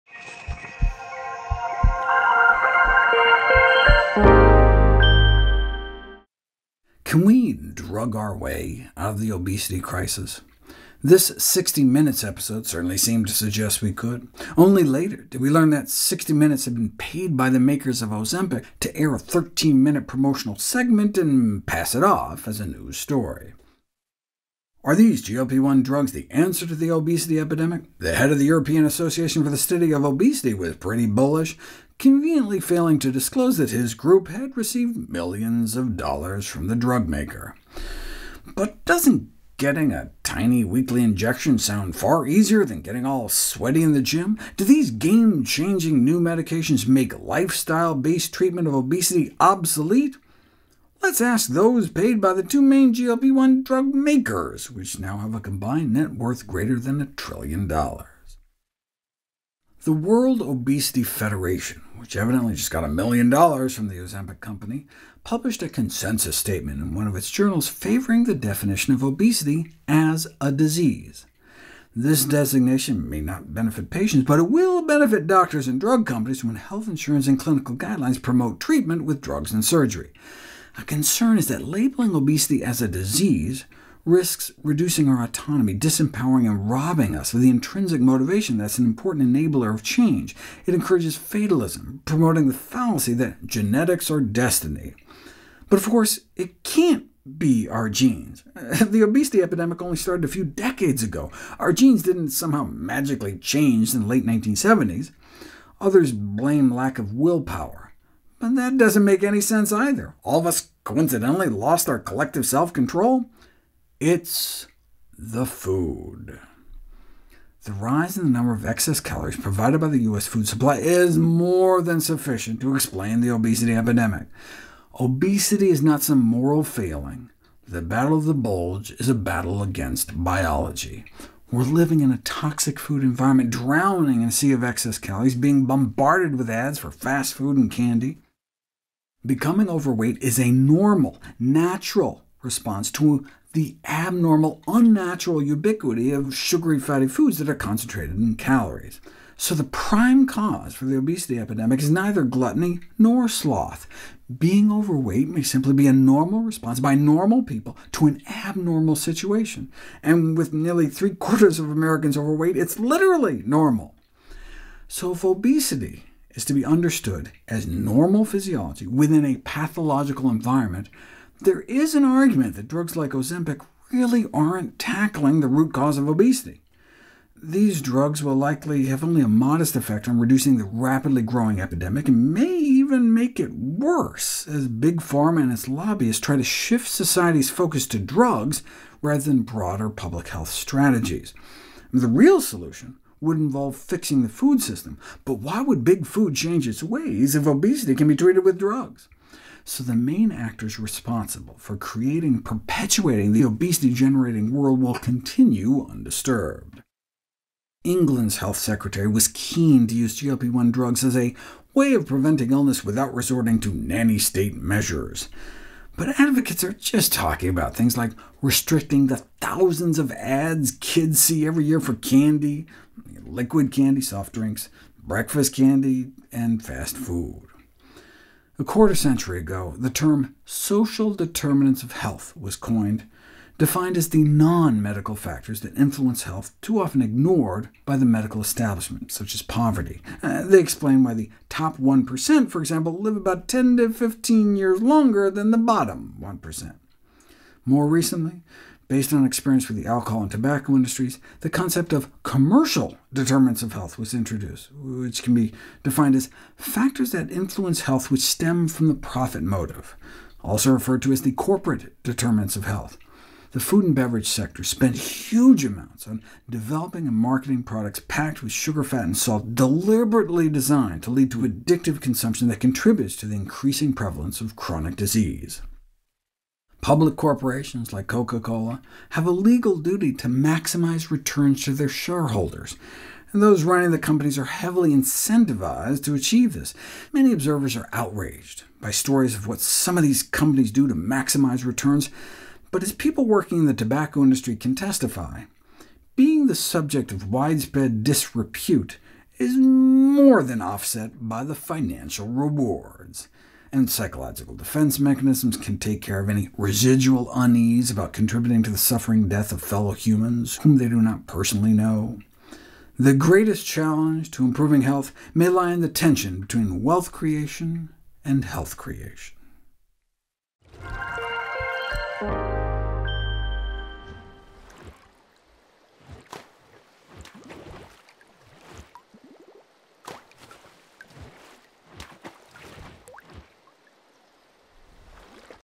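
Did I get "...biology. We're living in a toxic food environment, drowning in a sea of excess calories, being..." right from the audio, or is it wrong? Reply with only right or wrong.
right.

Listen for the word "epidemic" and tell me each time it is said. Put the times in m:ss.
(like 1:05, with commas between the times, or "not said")
0:27, 1:39, 2:03, 2:31, 3:01.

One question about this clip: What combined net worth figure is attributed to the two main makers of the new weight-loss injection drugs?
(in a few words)
greater than a trillion dollars.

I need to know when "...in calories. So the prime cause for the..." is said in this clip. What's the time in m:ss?
2:28.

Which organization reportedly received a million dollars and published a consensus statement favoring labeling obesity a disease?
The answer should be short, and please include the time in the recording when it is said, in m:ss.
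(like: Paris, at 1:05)
World Obesity Federation, at 0:59.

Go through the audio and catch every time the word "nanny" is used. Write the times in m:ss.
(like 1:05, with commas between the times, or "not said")
3:33.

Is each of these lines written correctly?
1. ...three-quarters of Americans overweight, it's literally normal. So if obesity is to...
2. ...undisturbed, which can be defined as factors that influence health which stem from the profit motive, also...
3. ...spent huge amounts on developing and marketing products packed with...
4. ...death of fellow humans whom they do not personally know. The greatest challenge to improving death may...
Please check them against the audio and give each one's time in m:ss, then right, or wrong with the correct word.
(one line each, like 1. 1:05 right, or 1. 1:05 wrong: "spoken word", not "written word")
1. 2:40 right
2. 4:14 wrong: "introduced", not "undisturbed"
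3. 4:24 right
4. 5:09 wrong: "health", not "death".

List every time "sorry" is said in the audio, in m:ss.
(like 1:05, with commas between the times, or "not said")
not said.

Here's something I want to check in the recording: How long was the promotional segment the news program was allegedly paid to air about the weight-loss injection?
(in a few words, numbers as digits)
13 minute.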